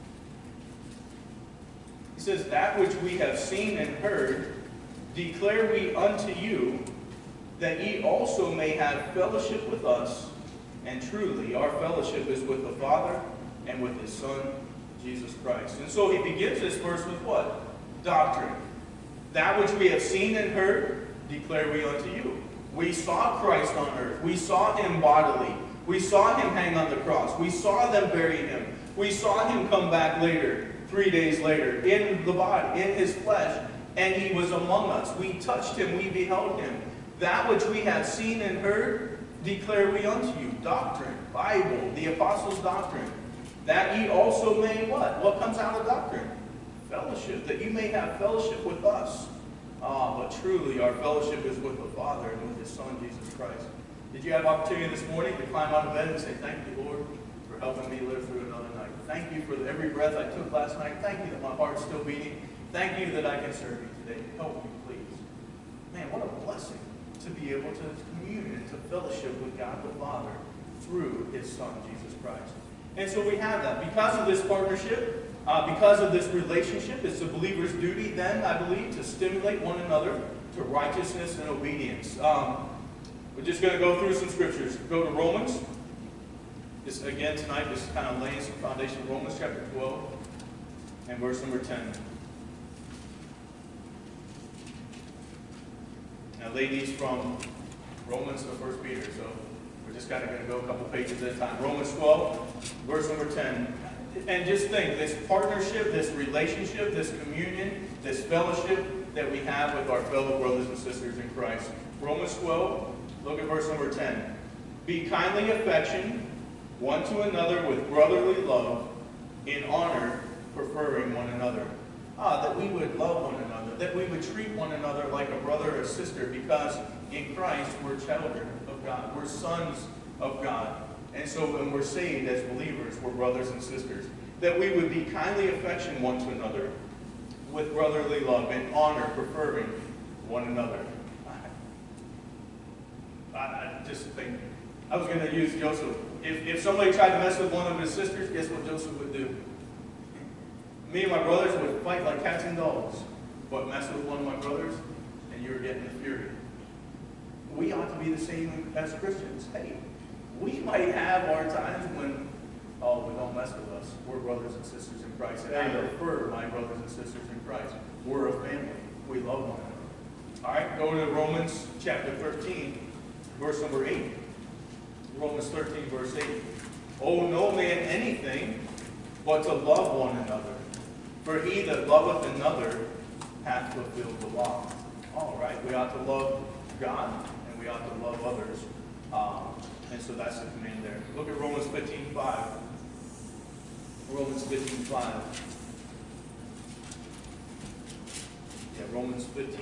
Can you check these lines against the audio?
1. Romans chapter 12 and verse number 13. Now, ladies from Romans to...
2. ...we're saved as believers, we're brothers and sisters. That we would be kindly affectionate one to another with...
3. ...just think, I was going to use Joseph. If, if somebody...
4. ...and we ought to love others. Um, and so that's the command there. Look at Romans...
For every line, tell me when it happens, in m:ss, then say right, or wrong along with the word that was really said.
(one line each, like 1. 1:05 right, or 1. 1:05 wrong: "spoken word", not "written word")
1. 1:29 wrong: "10", not "13"
2. 2:11 right
3. 2:23 right
4. 3:07 right.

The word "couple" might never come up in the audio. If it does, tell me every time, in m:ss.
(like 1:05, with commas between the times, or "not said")
1:40.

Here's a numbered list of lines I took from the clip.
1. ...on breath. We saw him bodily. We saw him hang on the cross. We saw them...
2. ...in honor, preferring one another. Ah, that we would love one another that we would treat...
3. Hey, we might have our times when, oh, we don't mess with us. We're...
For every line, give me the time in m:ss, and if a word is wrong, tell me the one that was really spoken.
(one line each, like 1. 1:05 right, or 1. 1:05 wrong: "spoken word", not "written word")
1. 0:23 wrong: "earth", not "breath"
2. 1:59 right
3. 2:39 right.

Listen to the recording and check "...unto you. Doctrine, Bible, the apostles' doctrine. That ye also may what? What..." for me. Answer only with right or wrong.
right.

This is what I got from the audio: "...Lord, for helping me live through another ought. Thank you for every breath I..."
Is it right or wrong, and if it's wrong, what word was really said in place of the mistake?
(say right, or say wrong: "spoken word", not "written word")
wrong: "night", not "ought".